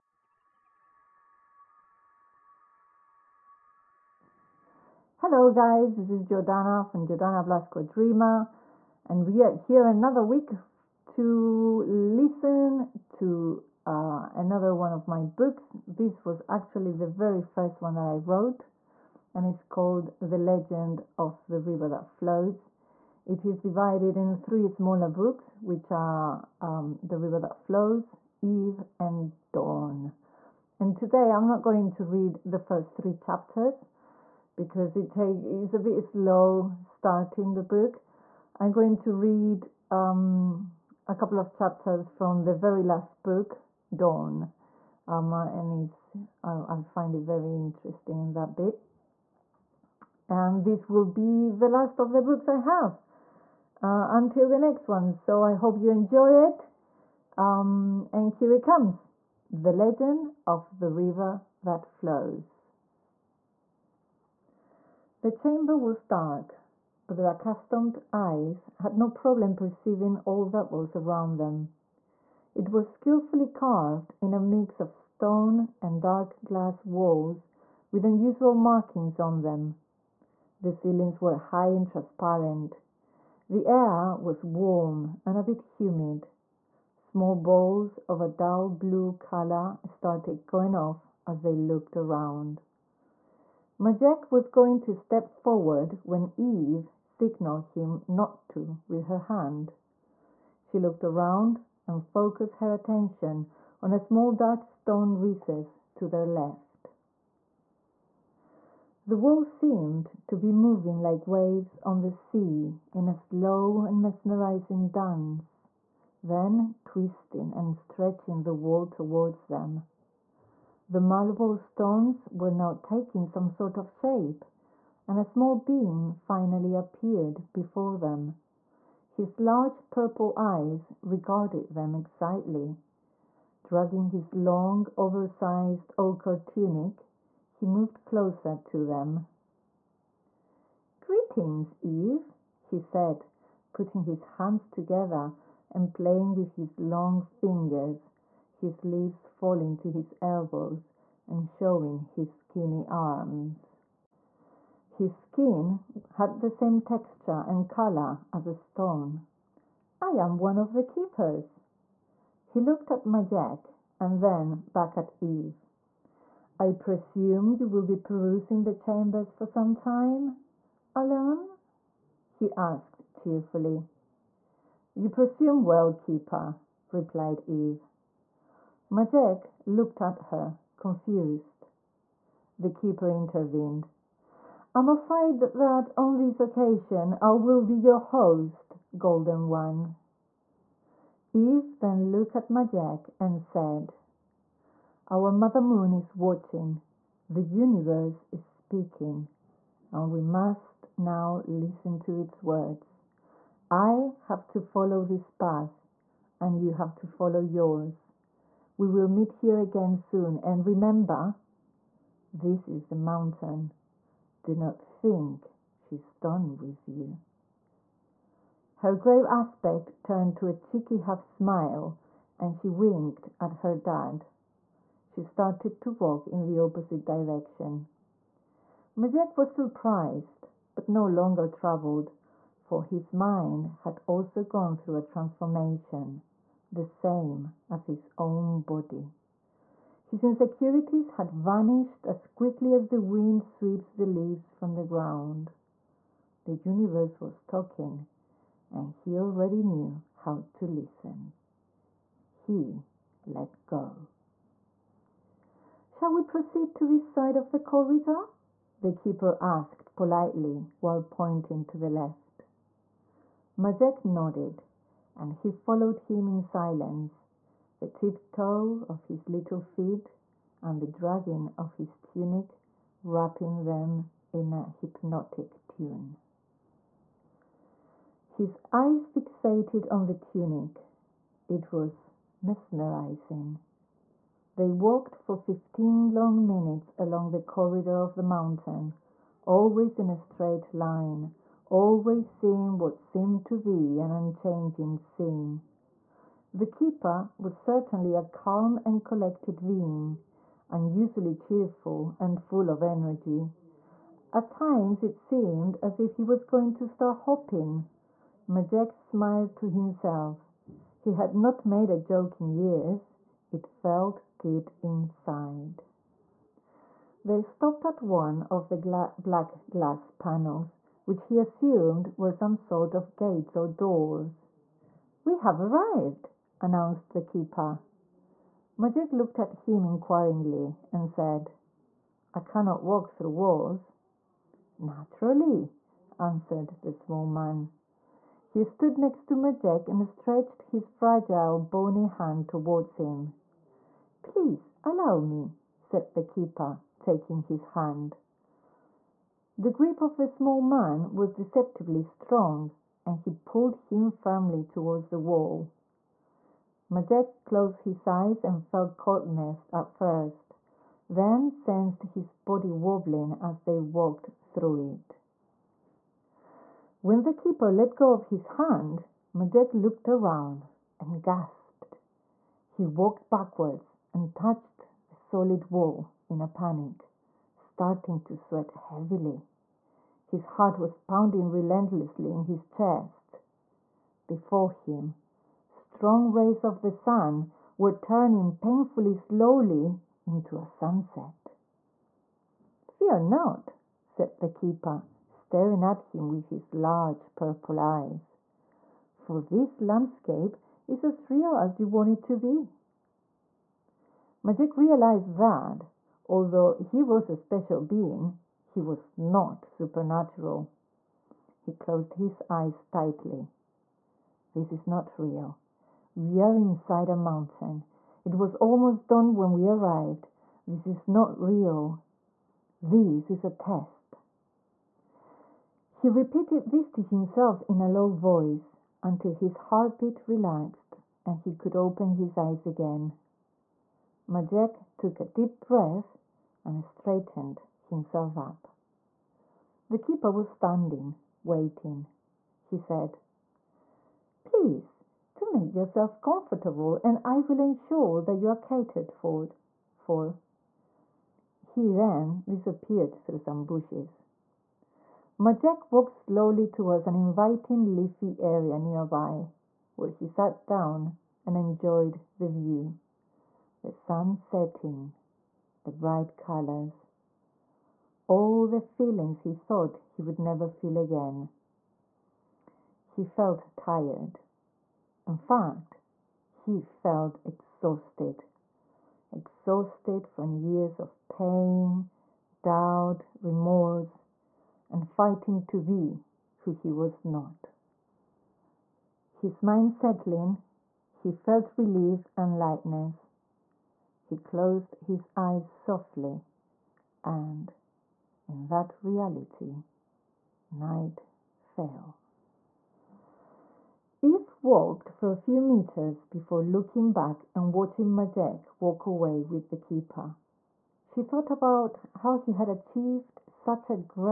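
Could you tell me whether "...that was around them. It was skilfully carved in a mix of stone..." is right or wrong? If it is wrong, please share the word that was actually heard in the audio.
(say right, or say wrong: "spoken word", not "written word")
right.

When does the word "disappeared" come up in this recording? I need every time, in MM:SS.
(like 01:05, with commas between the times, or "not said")
07:32.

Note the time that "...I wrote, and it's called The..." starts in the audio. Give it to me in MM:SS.
00:18.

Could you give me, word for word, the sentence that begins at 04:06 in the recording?
The universe was talking, and he already knew how to listen.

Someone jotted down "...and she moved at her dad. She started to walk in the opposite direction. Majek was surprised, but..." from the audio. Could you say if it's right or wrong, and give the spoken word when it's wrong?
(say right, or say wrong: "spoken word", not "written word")
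wrong: "winked", not "moved".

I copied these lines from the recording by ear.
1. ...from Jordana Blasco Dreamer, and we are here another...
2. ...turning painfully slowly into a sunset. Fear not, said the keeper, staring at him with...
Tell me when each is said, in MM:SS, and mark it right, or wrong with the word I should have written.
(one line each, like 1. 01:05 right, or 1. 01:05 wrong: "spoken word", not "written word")
1. 00:06 right
2. 06:27 right.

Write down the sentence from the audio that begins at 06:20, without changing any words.
His heart was pounding relentlessly in his chest.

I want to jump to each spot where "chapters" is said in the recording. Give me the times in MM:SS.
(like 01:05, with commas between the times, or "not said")
00:33, 00:41.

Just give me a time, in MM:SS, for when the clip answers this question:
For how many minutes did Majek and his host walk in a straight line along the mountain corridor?
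04:45.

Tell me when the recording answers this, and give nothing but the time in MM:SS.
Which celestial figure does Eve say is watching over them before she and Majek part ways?
03:15.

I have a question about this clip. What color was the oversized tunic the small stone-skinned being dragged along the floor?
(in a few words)
ochre.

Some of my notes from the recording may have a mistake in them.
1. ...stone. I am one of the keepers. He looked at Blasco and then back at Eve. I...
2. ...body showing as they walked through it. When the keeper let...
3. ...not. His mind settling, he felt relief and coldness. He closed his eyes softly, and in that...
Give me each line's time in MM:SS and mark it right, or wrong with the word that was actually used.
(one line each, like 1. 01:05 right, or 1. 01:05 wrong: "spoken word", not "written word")
1. 02:38 wrong: "Majek", not "Blasco"
2. 06:02 wrong: "wobbling", not "showing"
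3. 08:07 wrong: "lightness", not "coldness".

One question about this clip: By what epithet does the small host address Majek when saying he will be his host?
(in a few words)
Golden One.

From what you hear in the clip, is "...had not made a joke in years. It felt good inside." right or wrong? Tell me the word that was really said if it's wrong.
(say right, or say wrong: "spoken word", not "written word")
right.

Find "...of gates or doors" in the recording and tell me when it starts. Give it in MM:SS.
05:22.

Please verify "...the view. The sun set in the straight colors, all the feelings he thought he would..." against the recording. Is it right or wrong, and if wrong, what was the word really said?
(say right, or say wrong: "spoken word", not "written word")
wrong: "bright", not "straight".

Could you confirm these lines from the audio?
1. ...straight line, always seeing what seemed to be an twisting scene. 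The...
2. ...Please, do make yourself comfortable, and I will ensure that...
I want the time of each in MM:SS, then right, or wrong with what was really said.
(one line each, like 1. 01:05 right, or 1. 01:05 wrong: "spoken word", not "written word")
1. 04:50 wrong: "unchanging", not "twisting"
2. 07:24 right.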